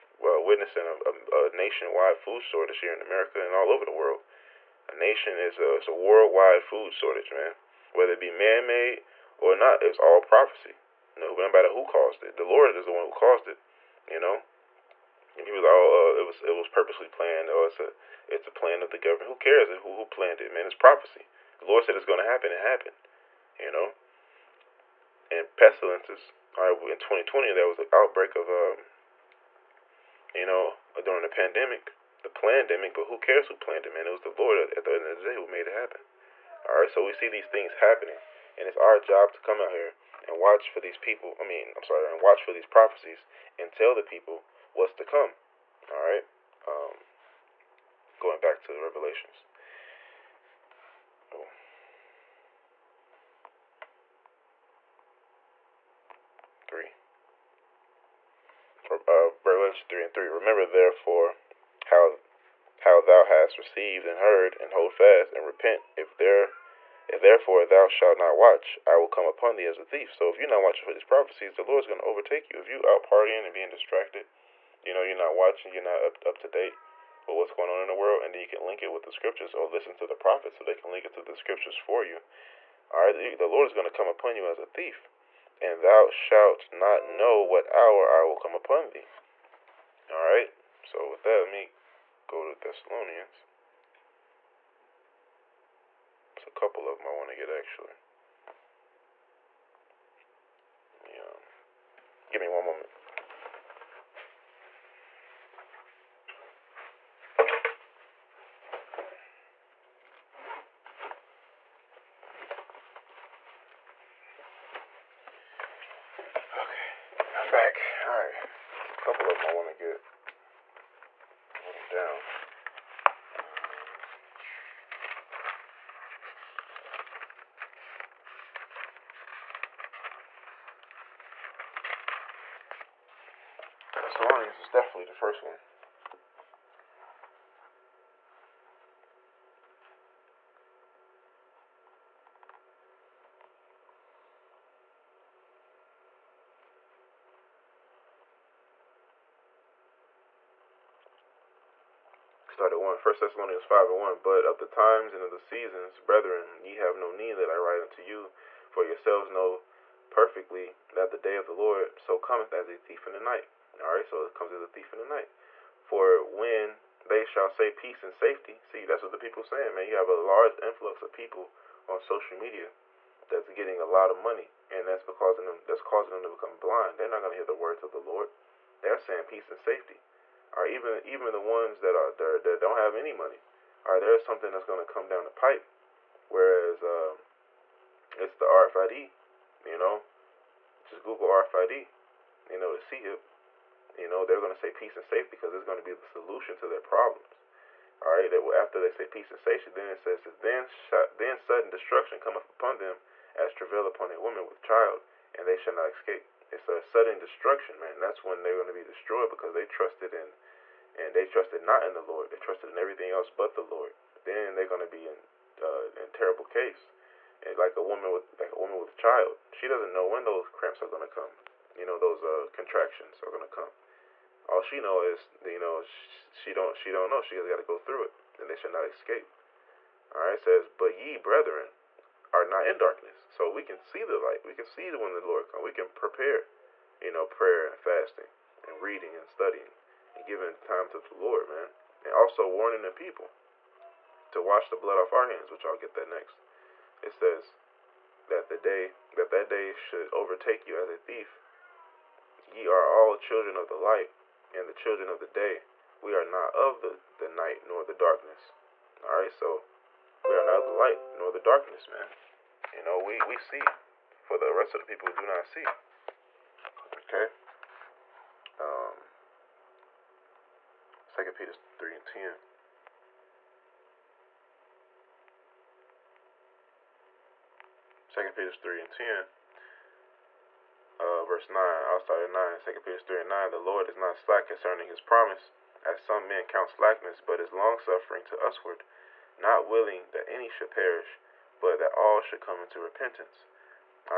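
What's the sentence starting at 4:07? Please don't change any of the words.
It says that the day that that day should overtake you as a thief.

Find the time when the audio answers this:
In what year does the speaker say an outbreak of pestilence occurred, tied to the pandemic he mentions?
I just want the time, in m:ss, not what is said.
0:26.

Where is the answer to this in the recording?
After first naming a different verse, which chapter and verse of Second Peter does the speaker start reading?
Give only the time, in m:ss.
4:42.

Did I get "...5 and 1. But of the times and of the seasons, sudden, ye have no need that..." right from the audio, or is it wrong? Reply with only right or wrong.
wrong.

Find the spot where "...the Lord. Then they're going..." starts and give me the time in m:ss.
3:33.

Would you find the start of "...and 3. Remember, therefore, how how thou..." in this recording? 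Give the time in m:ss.
1:00.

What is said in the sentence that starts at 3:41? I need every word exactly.
You know, those uh, contractions are going to come.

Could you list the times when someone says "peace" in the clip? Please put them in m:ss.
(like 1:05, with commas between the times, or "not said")
2:47, 2:59, 3:14, 3:19.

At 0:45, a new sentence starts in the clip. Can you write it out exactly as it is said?
All right, um, going back to the Revelations.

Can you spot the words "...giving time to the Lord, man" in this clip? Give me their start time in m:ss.
4:00.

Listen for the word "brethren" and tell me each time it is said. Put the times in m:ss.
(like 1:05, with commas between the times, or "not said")
2:35, 3:51.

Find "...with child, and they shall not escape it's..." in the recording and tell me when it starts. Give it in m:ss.
3:24.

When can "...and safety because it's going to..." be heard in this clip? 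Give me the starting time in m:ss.
3:14.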